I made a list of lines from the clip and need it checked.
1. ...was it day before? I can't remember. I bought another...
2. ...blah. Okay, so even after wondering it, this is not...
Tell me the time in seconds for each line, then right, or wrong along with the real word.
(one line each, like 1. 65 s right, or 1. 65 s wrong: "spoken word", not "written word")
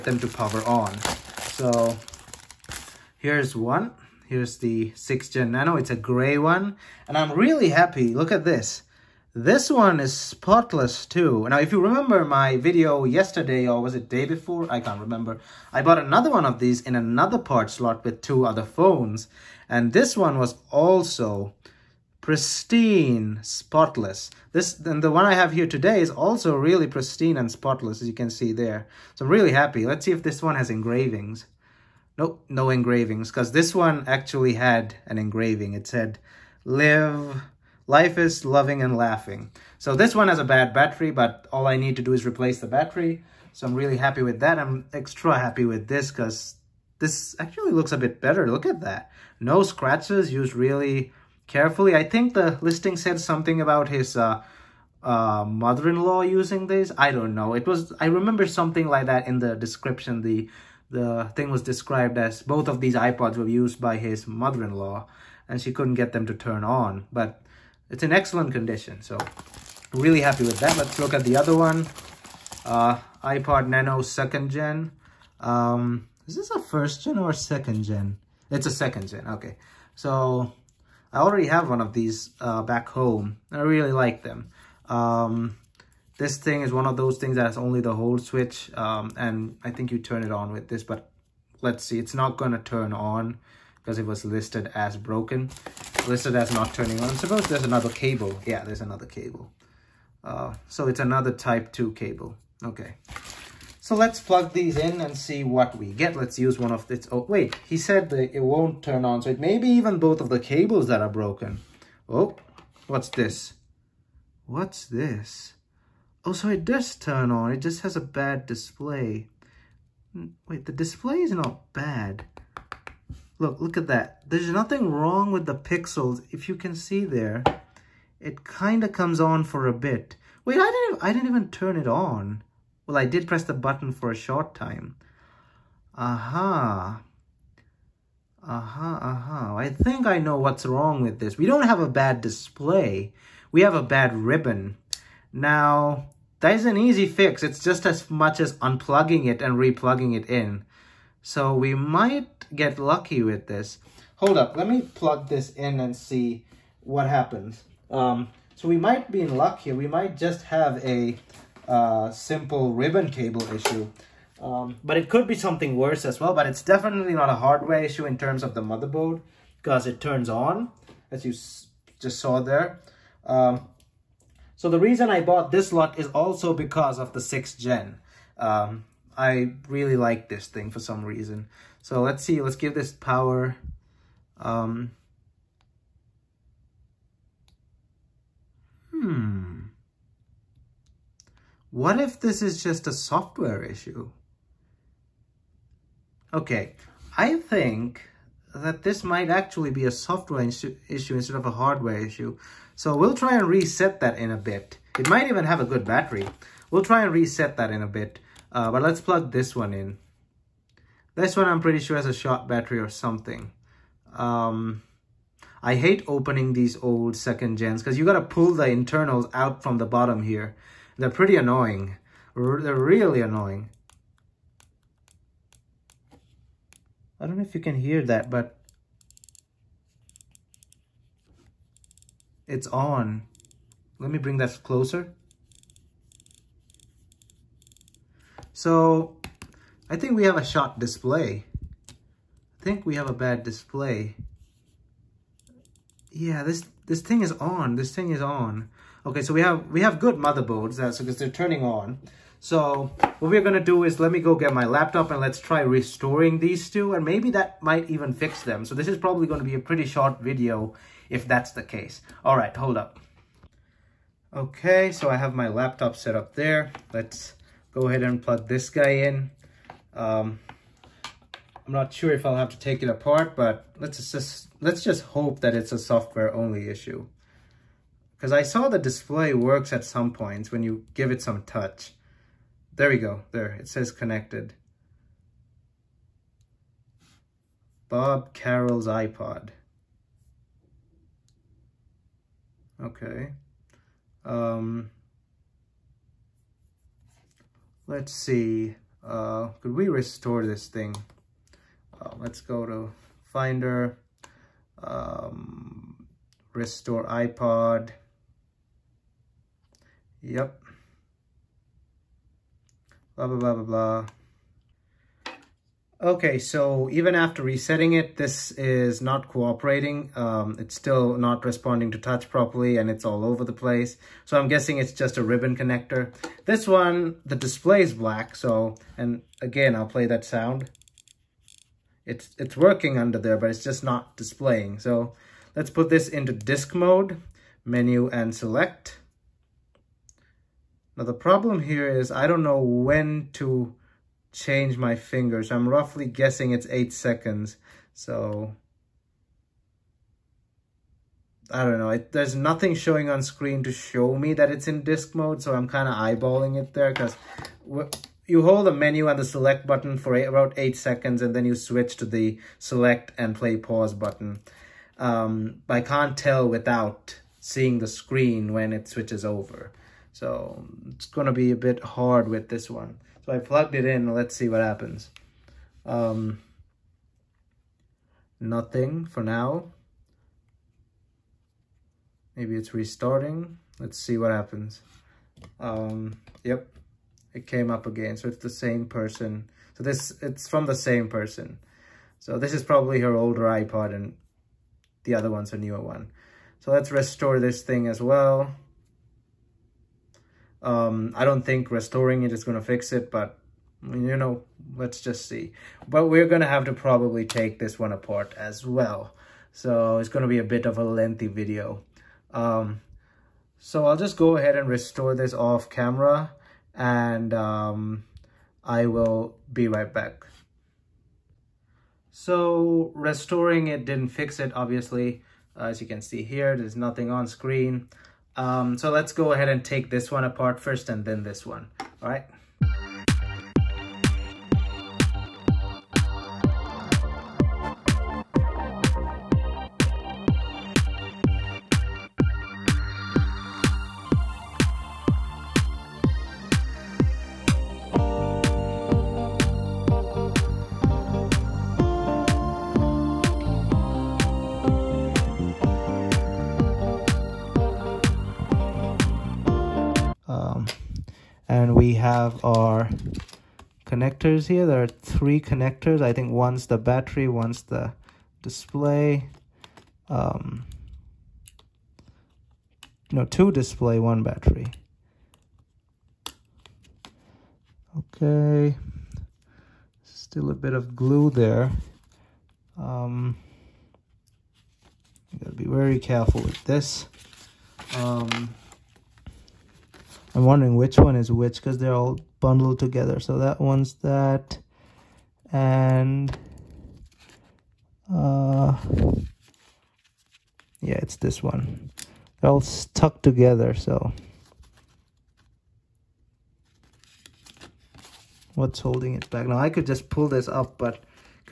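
1. 13 s right
2. 313 s wrong: "resetting", not "wondering".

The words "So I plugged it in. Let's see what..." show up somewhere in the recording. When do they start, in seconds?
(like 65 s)
373 s.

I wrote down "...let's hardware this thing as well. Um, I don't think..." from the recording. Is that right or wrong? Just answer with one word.
wrong.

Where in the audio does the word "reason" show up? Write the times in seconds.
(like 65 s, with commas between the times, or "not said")
174 s, 181 s.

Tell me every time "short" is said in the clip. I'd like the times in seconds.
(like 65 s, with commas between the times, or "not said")
134 s, 259 s.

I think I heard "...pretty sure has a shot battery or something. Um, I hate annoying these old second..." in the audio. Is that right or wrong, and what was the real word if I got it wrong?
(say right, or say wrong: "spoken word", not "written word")
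wrong: "opening", not "annoying".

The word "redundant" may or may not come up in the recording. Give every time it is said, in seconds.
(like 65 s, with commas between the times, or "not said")
not said.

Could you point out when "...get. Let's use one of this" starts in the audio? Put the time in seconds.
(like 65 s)
105 s.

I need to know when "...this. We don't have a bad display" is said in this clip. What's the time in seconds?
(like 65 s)
141 s.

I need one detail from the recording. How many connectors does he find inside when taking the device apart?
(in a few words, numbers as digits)
3.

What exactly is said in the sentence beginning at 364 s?
Um, I can't tell without seeing the screen when it switches over.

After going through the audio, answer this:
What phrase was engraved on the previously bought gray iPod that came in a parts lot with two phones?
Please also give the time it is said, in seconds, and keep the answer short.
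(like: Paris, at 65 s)
Life is loving and laughing, at 37 s.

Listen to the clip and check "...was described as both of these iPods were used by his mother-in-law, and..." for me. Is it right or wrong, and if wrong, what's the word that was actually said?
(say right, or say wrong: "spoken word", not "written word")
right.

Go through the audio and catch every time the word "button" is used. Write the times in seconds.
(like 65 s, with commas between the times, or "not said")
133 s, 359 s, 363 s.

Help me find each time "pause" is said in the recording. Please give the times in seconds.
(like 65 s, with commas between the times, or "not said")
363 s.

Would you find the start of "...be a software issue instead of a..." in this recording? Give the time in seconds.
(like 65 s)
199 s.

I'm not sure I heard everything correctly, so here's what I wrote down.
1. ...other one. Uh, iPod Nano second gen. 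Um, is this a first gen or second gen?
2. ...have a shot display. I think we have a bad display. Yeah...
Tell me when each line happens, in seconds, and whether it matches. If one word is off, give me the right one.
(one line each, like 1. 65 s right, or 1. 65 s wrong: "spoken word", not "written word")
1. 71 s right
2. 240 s right.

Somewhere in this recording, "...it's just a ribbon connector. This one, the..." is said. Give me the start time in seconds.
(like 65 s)
324 s.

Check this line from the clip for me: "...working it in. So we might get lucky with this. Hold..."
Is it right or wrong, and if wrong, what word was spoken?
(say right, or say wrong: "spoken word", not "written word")
wrong: "replugging", not "working".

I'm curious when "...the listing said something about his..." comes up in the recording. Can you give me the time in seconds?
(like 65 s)
52 s.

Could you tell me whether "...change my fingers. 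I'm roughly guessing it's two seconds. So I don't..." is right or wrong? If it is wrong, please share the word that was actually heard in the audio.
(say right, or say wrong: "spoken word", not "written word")
wrong: "eight", not "two".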